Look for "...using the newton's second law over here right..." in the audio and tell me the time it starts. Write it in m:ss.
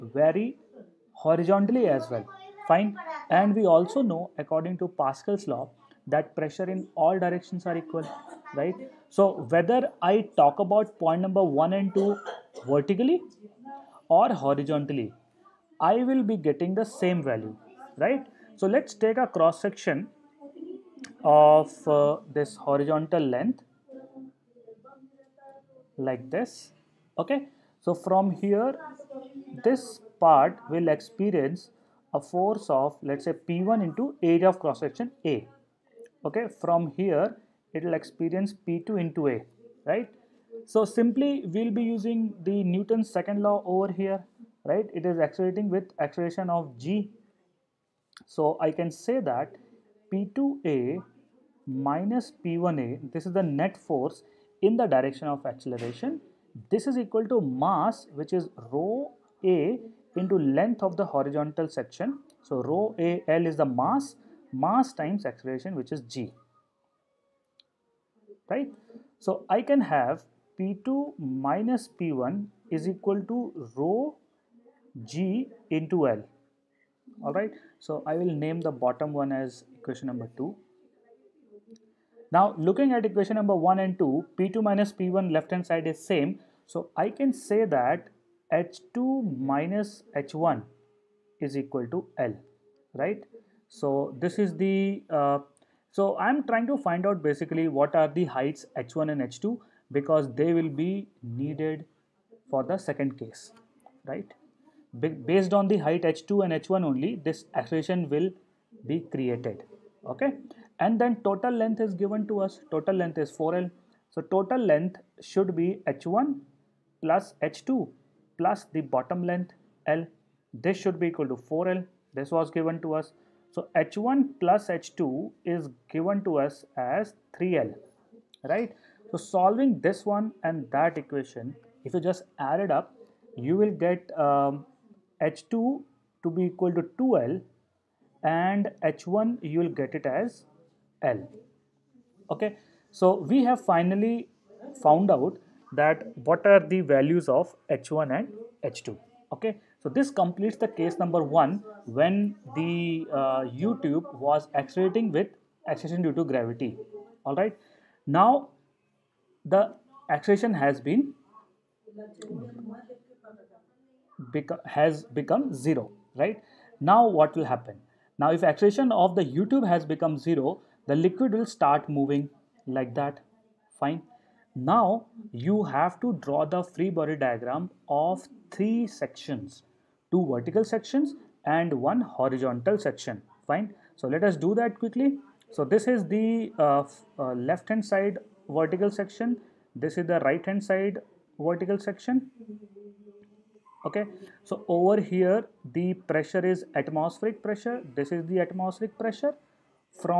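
0:41.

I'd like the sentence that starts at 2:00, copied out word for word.
This should be equal to 4L.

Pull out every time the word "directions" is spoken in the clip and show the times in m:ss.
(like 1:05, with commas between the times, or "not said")
0:07, 0:54.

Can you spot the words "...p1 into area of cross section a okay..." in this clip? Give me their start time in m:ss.
0:33.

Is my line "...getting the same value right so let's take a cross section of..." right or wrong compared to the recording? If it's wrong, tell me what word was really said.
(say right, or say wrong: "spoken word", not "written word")
right.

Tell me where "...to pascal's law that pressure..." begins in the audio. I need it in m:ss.
0:04.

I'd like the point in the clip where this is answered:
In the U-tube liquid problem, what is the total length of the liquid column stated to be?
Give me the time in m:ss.
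1:52.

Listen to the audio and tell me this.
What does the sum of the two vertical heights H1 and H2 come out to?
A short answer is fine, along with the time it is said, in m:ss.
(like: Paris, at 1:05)
3L, at 2:07.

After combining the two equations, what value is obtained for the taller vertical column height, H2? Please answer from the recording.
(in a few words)
2L.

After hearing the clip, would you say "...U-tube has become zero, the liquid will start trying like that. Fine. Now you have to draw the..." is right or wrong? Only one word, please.
wrong.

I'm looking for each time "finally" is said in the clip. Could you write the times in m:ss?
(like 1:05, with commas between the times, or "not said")
2:23.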